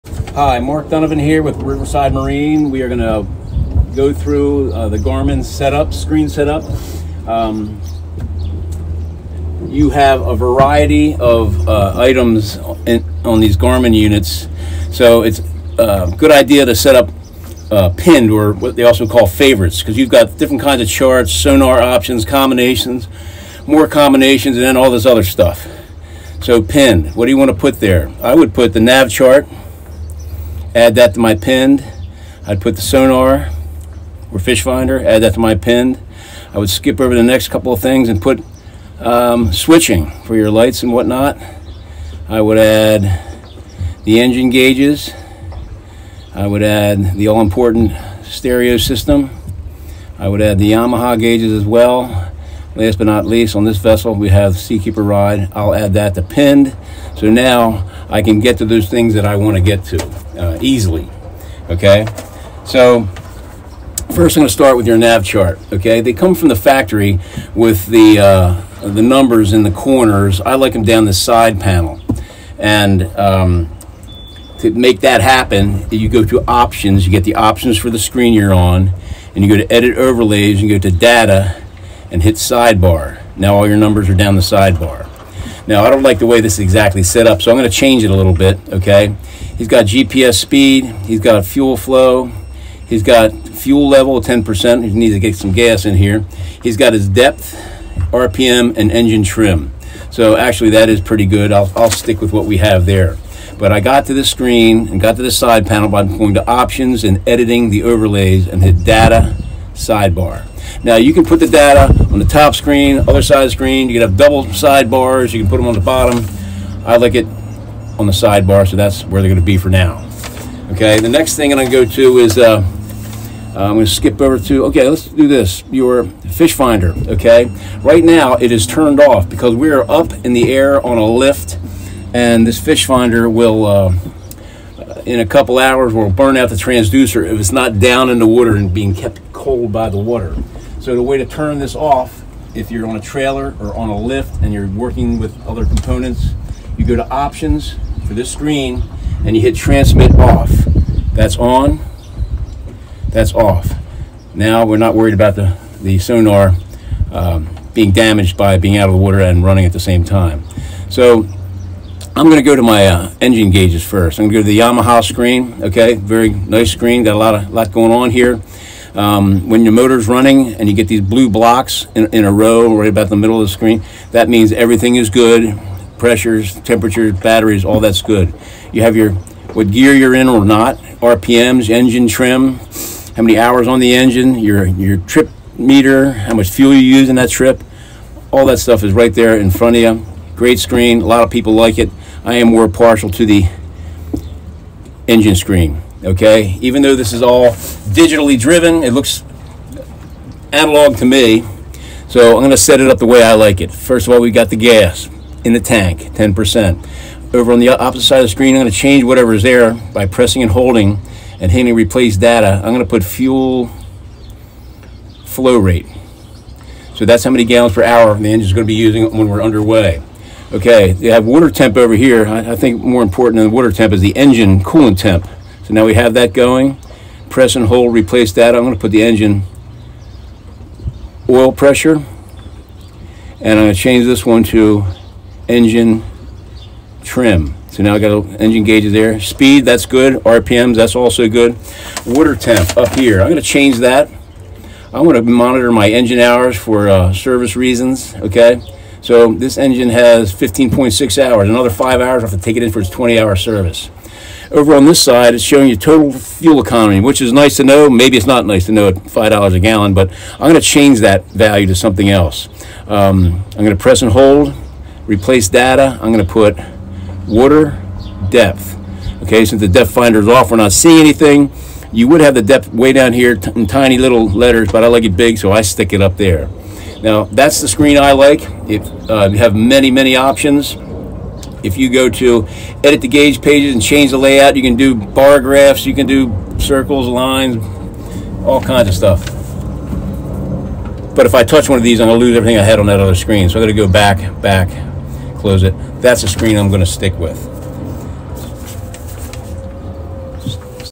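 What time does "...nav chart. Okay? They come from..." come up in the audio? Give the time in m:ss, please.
1:04.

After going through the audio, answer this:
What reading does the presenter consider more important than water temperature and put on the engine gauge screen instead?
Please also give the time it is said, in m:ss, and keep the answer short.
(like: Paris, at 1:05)
engine coolant temp, at 3:44.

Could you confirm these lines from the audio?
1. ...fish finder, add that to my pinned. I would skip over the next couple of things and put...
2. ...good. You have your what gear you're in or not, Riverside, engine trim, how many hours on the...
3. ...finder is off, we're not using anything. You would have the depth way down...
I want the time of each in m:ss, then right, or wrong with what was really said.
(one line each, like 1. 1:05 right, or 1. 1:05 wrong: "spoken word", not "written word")
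1. 0:34 right
2. 2:58 wrong: "RPMs", not "Riverside"
3. 4:29 wrong: "seeing", not "using".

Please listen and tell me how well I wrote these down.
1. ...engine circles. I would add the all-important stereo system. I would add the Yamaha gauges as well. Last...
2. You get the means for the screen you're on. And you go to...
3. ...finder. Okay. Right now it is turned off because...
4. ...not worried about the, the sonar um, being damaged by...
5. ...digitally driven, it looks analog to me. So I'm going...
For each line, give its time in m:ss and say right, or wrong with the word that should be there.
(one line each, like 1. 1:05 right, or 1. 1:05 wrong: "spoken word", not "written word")
1. 0:44 wrong: "gauges", not "circles"
2. 1:17 wrong: "options", not "means"
3. 2:06 right
4. 2:34 right
5. 3:17 right.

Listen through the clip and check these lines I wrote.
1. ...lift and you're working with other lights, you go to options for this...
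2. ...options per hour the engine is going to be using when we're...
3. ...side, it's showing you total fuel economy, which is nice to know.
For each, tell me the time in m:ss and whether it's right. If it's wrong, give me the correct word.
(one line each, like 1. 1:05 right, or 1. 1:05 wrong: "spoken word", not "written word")
1. 2:23 wrong: "components", not "lights"
2. 3:37 wrong: "gallons", not "options"
3. 4:15 right.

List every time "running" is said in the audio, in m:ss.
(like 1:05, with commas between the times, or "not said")
2:39, 2:50.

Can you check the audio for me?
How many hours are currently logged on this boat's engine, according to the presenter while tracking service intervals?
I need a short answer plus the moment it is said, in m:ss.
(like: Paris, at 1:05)
15.6 hours, at 4:10.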